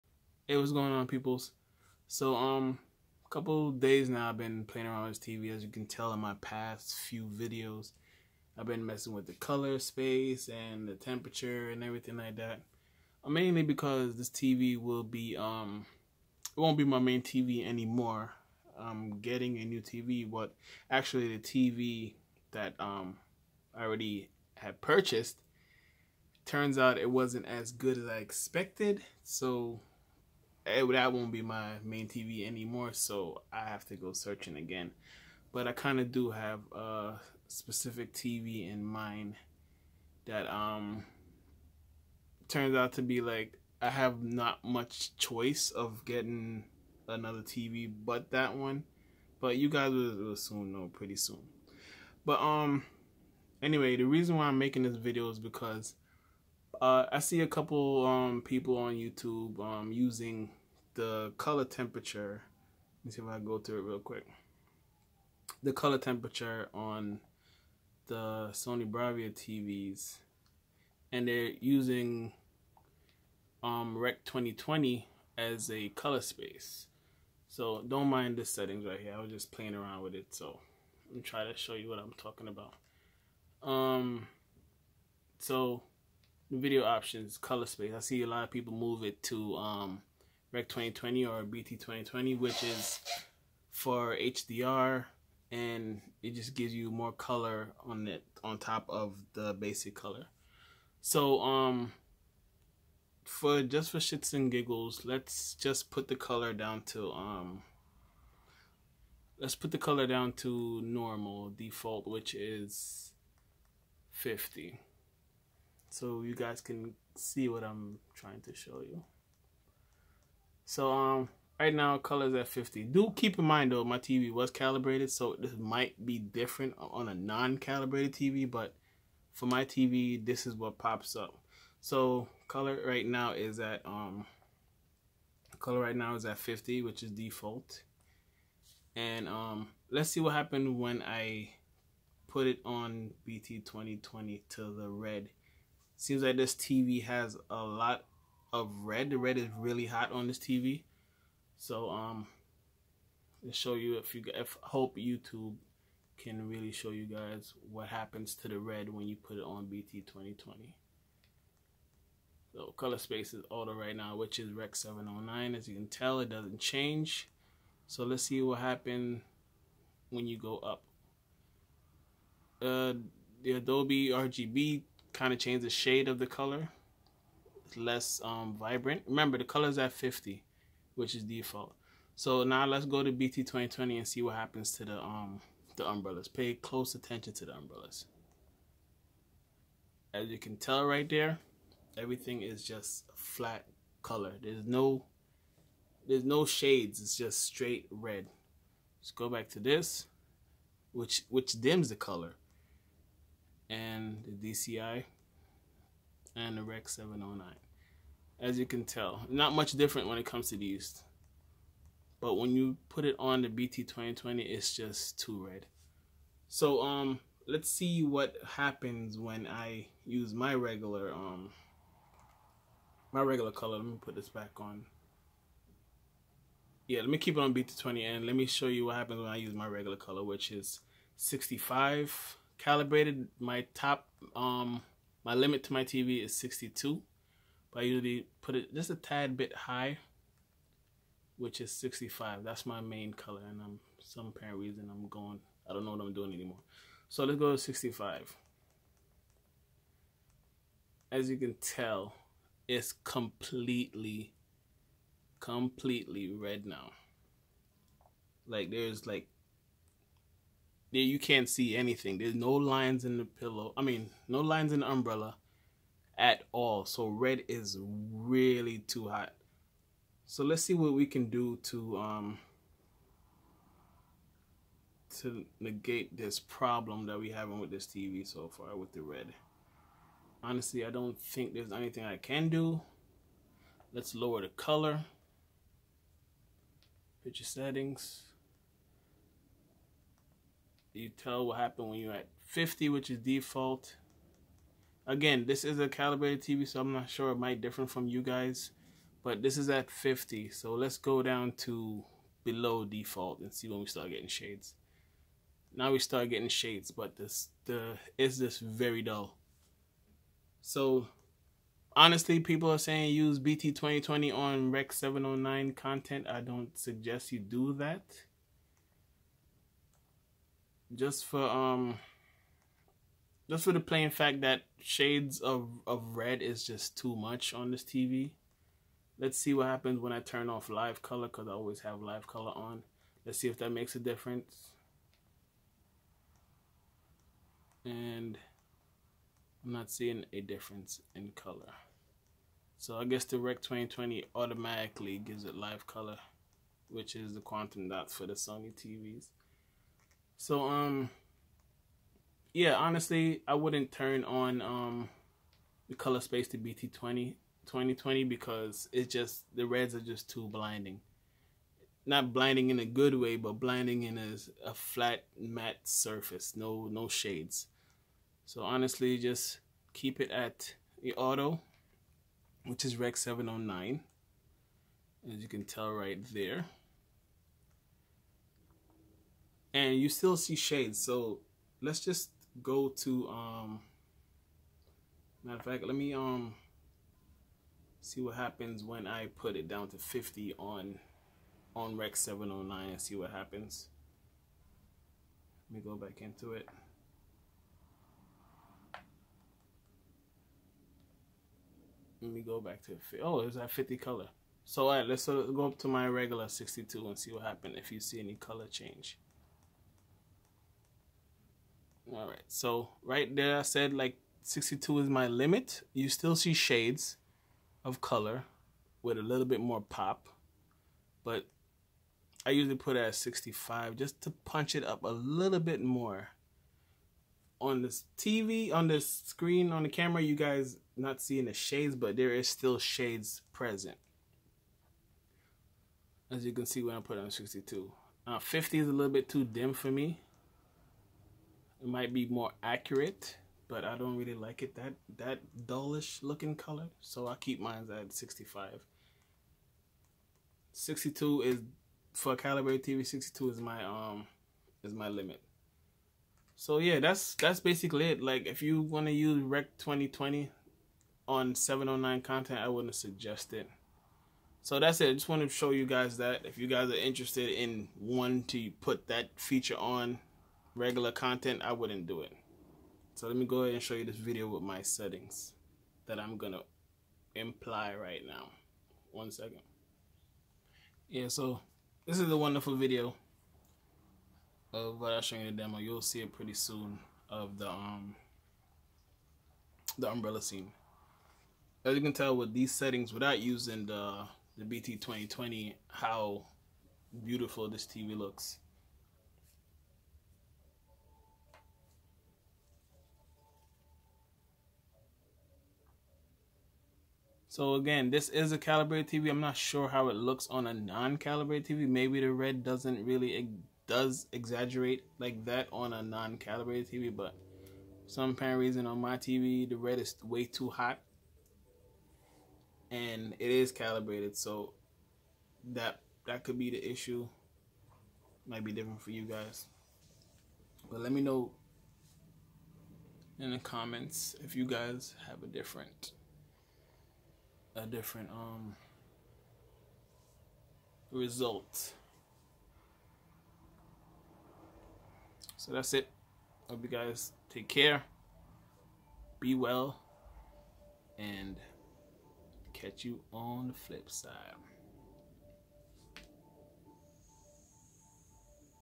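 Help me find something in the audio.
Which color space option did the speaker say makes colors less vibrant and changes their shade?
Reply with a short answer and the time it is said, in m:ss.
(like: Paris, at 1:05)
Adobe RGB, at 2:53.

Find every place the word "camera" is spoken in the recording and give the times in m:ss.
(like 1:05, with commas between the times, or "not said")
7:09.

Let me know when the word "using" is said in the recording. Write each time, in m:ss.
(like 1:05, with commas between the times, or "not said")
0:59, 1:11, 8:13.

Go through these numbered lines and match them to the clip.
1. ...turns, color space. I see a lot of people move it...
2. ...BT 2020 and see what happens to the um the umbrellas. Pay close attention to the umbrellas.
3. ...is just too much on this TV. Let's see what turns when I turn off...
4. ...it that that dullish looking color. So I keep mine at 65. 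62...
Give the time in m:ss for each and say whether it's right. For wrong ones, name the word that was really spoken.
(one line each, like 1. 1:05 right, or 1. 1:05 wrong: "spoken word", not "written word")
1. 1:26 wrong: "options", not "turns"
2. 3:03 right
3. 5:26 wrong: "happens", not "turns"
4. 7:24 right.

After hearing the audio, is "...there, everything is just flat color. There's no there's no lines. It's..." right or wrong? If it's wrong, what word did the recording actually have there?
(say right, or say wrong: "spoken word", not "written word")
wrong: "shades", not "lines".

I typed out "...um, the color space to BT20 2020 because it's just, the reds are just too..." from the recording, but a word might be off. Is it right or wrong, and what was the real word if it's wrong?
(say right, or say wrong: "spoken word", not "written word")
right.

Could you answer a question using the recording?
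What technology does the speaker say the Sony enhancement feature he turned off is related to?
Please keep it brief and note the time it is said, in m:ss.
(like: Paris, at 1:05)
quantum dot, at 5:47.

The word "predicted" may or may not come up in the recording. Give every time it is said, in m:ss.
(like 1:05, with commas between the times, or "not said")
not said.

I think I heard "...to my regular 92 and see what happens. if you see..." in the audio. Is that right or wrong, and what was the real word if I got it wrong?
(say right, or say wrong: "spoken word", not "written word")
wrong: "62", not "92".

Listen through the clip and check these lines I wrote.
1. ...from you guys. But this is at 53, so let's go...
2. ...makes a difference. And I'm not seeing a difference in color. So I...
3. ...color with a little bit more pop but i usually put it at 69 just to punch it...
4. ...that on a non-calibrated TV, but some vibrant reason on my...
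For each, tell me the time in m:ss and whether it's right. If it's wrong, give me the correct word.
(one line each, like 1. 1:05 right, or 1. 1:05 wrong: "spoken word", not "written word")
1. 4:57 wrong: "50", not "53"
2. 5:33 right
3. 6:58 wrong: "65", not "69"
4. 8:35 wrong: "apparent", not "vibrant".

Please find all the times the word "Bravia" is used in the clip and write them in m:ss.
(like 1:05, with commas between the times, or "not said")
1:08.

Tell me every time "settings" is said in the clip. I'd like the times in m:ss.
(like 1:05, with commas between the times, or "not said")
1:18, 4:47, 7:54, 8:12.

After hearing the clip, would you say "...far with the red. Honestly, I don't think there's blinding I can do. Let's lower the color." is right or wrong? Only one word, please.
wrong.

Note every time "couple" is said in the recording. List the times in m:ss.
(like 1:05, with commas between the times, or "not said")
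0:03, 0:57.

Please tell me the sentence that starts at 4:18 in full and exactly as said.
Like there's like there you can't see anything.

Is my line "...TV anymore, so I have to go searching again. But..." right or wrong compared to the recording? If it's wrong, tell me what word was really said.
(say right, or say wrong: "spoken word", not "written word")
right.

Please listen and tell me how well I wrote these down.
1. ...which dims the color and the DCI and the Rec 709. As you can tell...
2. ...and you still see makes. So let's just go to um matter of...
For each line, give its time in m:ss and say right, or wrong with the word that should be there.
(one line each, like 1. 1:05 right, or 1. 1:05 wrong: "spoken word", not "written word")
1. 3:21 right
2. 6:19 wrong: "shades", not "makes".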